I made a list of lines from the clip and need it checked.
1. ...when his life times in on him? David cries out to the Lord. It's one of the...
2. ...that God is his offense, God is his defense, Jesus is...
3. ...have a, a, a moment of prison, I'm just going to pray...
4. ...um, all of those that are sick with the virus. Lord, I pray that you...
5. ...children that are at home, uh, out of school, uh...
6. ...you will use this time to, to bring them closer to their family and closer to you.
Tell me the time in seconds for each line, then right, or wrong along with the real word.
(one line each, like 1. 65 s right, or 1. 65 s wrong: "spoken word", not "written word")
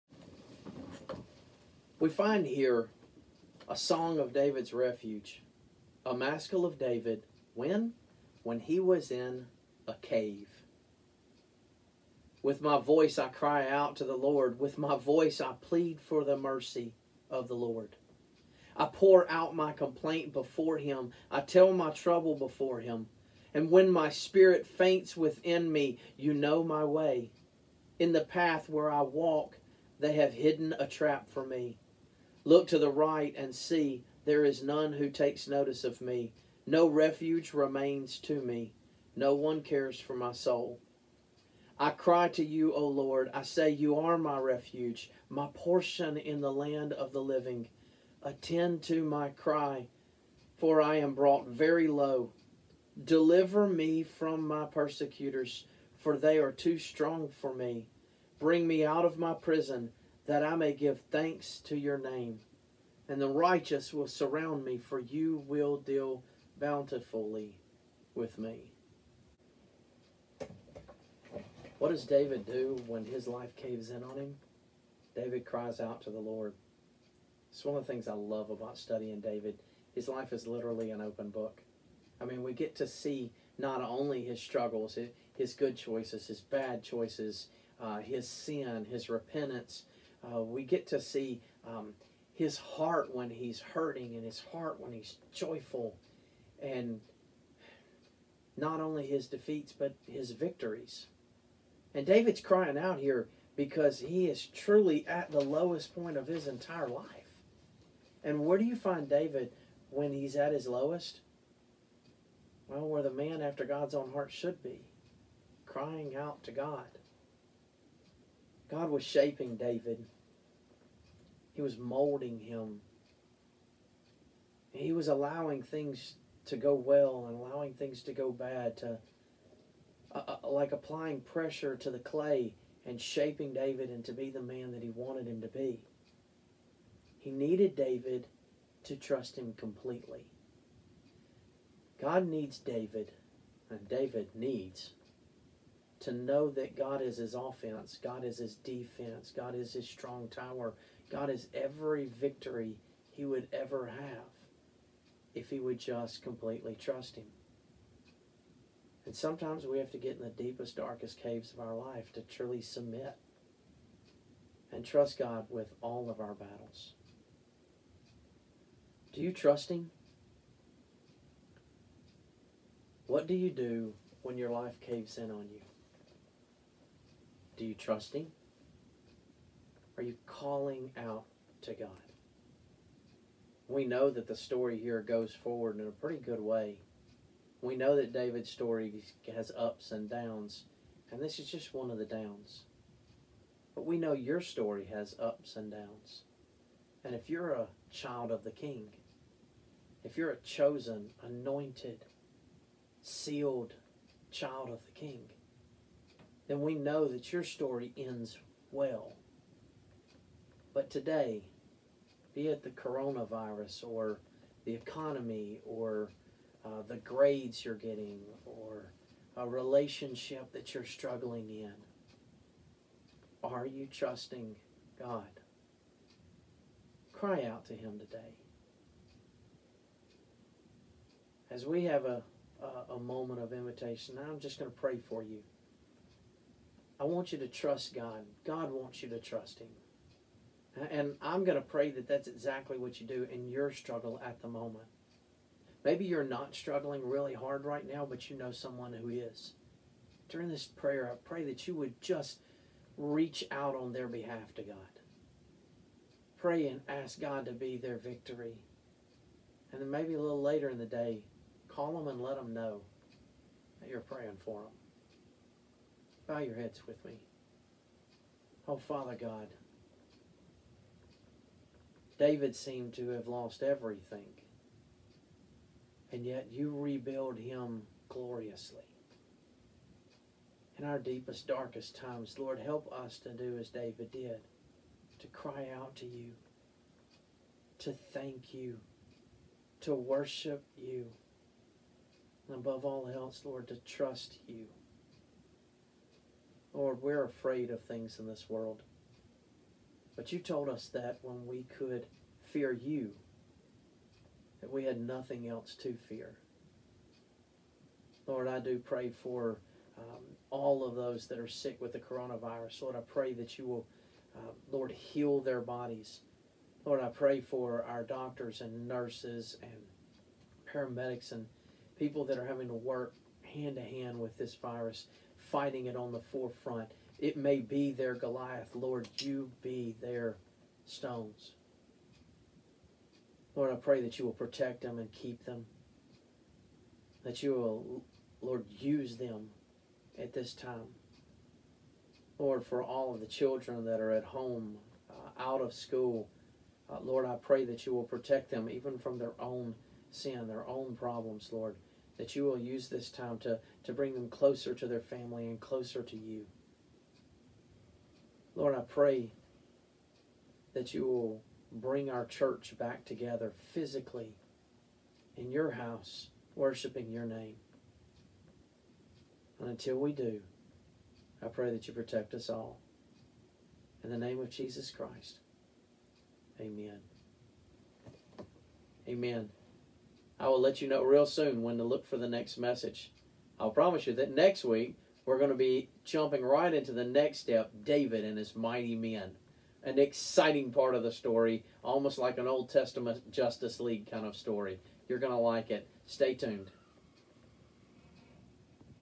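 1. 72 s wrong: "caves", not "times"
2. 146 s wrong: "God", not "Jesus"
3. 231 s wrong: "invitation", not "prison"
4. 309 s wrong: "coronavirus", not "virus"
5. 343 s right
6. 352 s right.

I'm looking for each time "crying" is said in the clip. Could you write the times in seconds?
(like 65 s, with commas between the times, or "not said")
102 s, 115 s.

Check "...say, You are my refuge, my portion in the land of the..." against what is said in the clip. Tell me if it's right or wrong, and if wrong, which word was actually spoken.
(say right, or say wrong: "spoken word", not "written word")
right.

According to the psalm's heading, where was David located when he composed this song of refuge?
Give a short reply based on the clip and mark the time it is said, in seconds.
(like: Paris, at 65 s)
In a cave, at 9 s.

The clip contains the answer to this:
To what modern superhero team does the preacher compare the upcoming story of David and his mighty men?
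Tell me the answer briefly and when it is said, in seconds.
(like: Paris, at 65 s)
Justice League, at 393 s.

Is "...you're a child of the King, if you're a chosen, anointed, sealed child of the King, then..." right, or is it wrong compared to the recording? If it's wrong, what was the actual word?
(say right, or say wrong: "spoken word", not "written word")
right.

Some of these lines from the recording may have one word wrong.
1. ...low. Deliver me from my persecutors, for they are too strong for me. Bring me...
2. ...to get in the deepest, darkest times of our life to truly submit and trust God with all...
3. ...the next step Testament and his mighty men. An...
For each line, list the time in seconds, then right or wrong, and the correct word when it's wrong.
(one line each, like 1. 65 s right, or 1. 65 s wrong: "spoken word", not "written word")
1. 51 s right
2. 159 s wrong: "caves", not "times"
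3. 386 s wrong: "David", not "Testament".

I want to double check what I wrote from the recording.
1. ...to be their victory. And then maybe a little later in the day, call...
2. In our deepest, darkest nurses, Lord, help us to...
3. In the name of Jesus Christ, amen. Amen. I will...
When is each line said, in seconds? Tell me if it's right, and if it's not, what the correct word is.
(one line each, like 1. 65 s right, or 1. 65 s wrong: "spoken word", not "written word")
1. 257 s right
2. 280 s wrong: "times", not "nurses"
3. 374 s right.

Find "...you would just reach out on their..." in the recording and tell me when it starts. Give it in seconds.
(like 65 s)
251 s.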